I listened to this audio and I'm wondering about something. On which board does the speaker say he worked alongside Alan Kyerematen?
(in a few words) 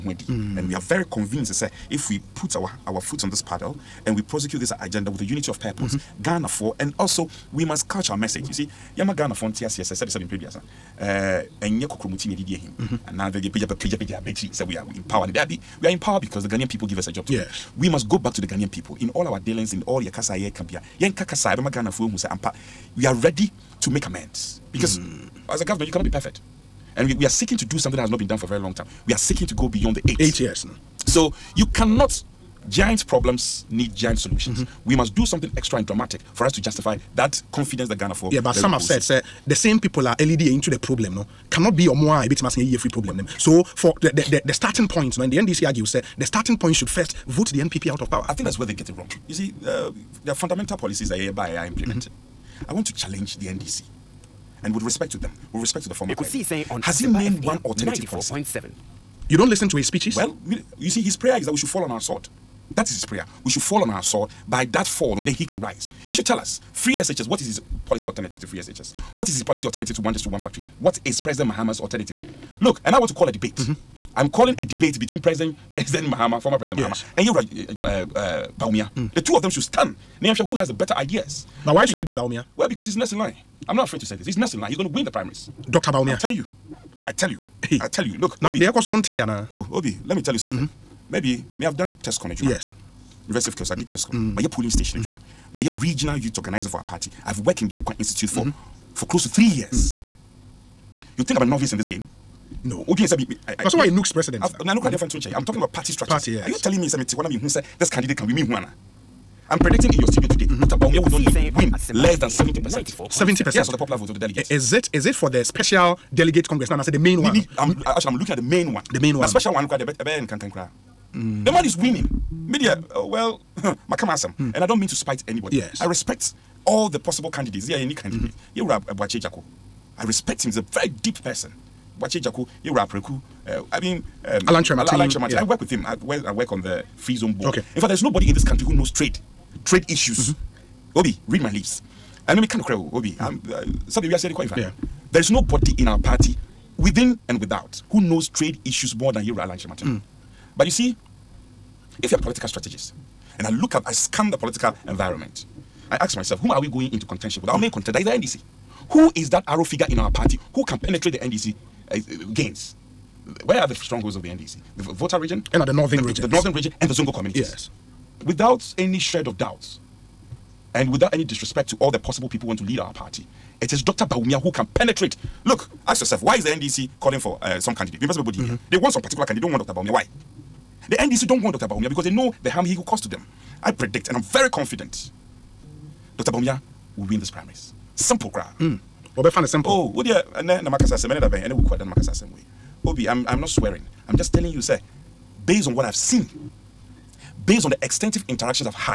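free zone board.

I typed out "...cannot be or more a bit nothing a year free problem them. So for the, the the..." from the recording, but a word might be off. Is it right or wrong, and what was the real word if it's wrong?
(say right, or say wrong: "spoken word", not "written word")
wrong: "massing", not "nothing".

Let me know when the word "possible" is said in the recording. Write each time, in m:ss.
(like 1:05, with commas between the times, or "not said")
2:06, 2:51.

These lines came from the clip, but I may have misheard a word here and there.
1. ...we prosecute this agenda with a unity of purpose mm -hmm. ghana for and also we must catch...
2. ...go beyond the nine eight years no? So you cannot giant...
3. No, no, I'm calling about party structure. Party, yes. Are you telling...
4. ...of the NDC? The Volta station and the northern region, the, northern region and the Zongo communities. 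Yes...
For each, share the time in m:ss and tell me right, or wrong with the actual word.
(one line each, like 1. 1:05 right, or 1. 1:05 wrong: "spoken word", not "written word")
1. 0:04 right
2. 0:29 wrong: "eight", not "nine"
3. 1:44 wrong: "talking", not "calling"
4. 2:44 wrong: "region", not "station".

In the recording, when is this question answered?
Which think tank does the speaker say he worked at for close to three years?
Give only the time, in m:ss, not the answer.
1:37.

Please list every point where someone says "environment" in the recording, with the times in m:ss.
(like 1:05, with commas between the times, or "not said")
2:34.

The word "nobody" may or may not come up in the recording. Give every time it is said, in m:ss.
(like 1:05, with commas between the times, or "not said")
2:18, 2:25.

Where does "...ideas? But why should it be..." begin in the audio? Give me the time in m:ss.
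1:21.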